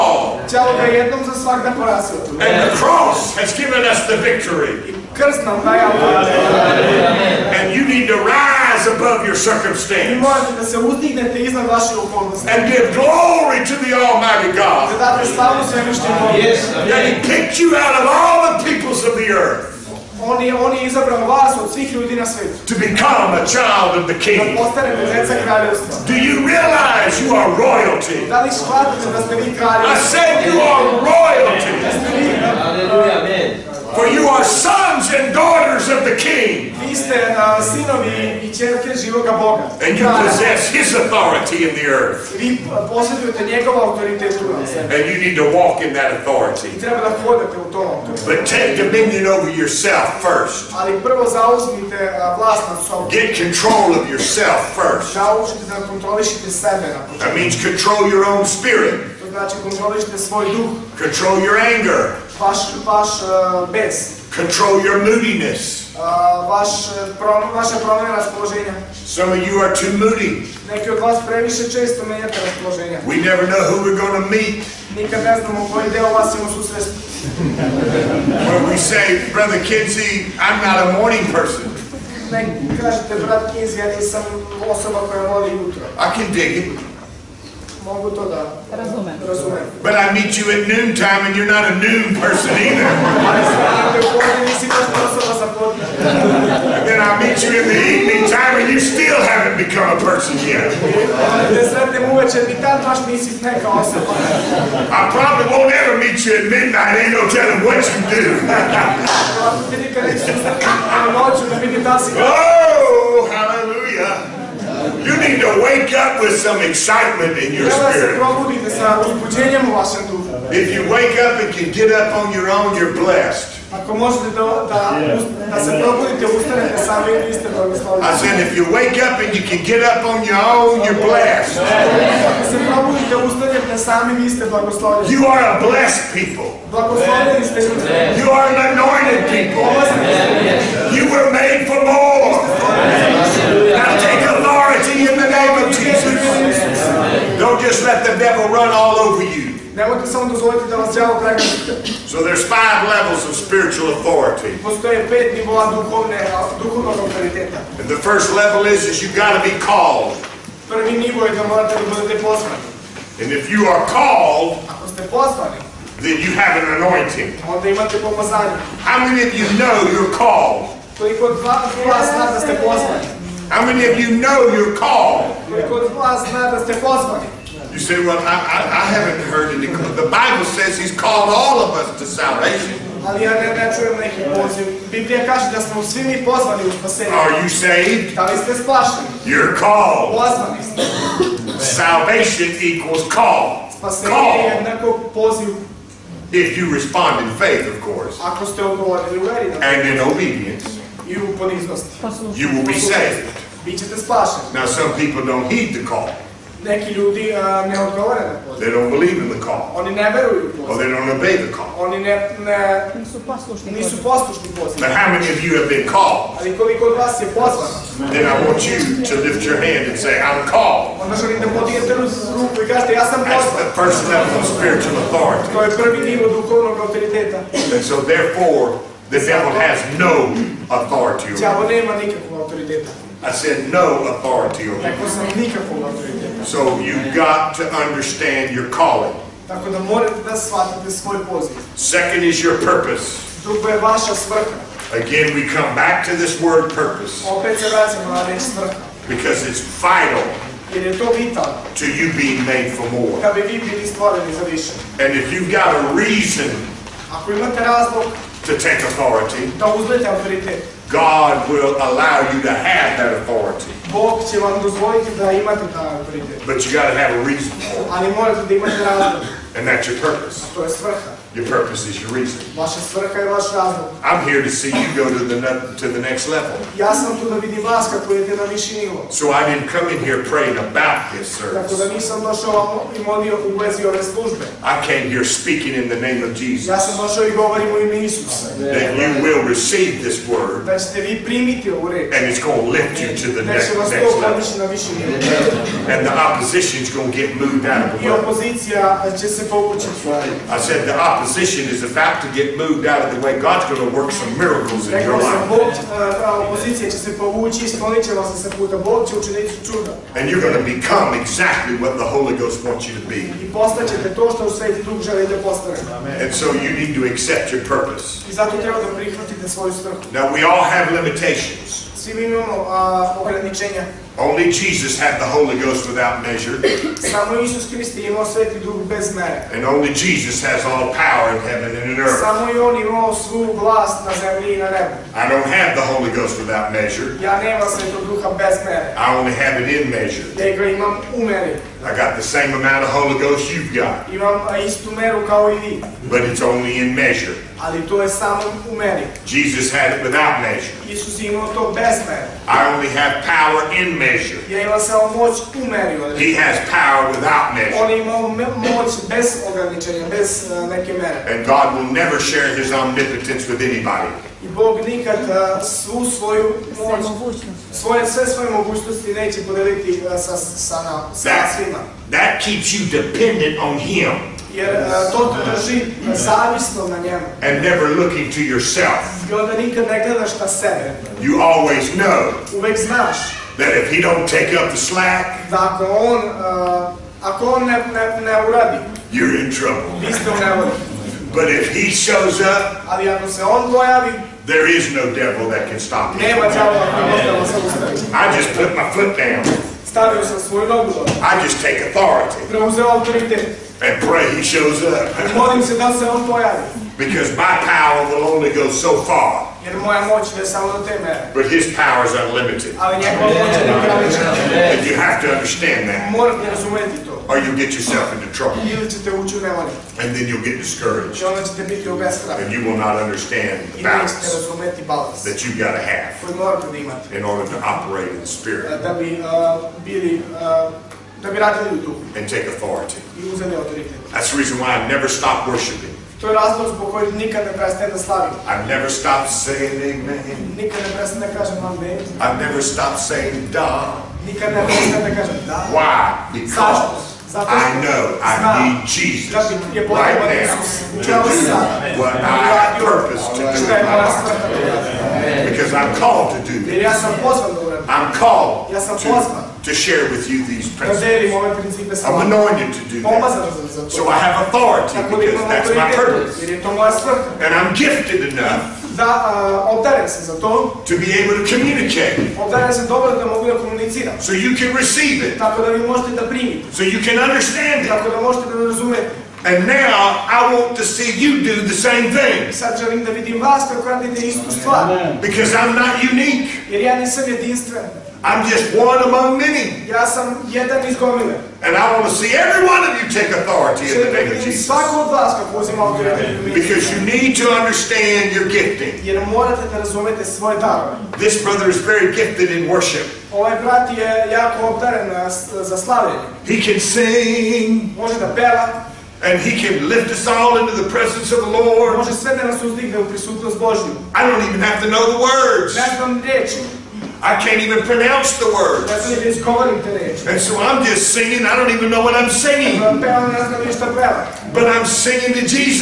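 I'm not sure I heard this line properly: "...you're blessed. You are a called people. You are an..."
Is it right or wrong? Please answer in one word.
wrong.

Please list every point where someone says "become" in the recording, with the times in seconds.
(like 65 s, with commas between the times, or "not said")
22 s, 99 s, 310 s.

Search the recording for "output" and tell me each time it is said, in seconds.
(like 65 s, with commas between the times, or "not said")
not said.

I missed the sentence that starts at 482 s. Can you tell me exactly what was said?
Sad želim da vidim vas kako radite istu stvar.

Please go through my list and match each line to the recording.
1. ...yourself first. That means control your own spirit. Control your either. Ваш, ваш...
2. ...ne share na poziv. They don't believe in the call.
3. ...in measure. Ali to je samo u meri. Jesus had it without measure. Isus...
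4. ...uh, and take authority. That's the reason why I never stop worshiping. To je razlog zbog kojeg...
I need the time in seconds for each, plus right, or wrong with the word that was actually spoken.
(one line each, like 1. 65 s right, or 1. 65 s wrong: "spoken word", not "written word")
1. 54 s wrong: "anger", not "either"
2. 207 s wrong: "odgovore", not "share"
3. 346 s right
4. 430 s right.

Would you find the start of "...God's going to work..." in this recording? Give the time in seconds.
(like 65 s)
303 s.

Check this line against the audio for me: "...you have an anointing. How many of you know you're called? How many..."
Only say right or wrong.
right.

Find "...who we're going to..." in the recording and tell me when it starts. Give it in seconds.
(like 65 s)
73 s.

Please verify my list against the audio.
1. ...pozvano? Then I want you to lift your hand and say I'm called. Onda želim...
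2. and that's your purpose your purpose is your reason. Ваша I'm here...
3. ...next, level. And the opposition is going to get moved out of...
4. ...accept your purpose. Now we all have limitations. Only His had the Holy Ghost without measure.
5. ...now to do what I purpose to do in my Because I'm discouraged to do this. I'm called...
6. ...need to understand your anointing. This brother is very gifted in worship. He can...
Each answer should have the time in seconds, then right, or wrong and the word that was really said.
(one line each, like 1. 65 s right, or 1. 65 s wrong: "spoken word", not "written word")
1. 217 s right
2. 269 s right
3. 293 s right
4. 317 s wrong: "Jesus", not "His"
5. 449 s wrong: "called", not "discouraged"
6. 497 s wrong: "gifting", not "anointing".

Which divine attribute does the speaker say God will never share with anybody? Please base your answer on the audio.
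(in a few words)
omnipotence.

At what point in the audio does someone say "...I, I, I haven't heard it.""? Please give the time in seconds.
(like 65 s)
178 s.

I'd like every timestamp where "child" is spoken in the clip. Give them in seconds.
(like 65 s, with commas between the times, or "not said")
23 s.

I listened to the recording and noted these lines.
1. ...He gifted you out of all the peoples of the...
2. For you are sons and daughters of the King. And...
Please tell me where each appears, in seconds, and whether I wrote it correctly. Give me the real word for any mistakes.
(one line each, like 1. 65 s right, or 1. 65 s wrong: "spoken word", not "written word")
1. 17 s wrong: "picked", not "gifted"
2. 33 s right.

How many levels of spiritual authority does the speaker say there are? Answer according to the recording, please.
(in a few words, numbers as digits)
5.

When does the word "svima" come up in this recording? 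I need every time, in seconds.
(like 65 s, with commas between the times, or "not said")
371 s.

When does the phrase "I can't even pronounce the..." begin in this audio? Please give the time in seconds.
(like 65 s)
517 s.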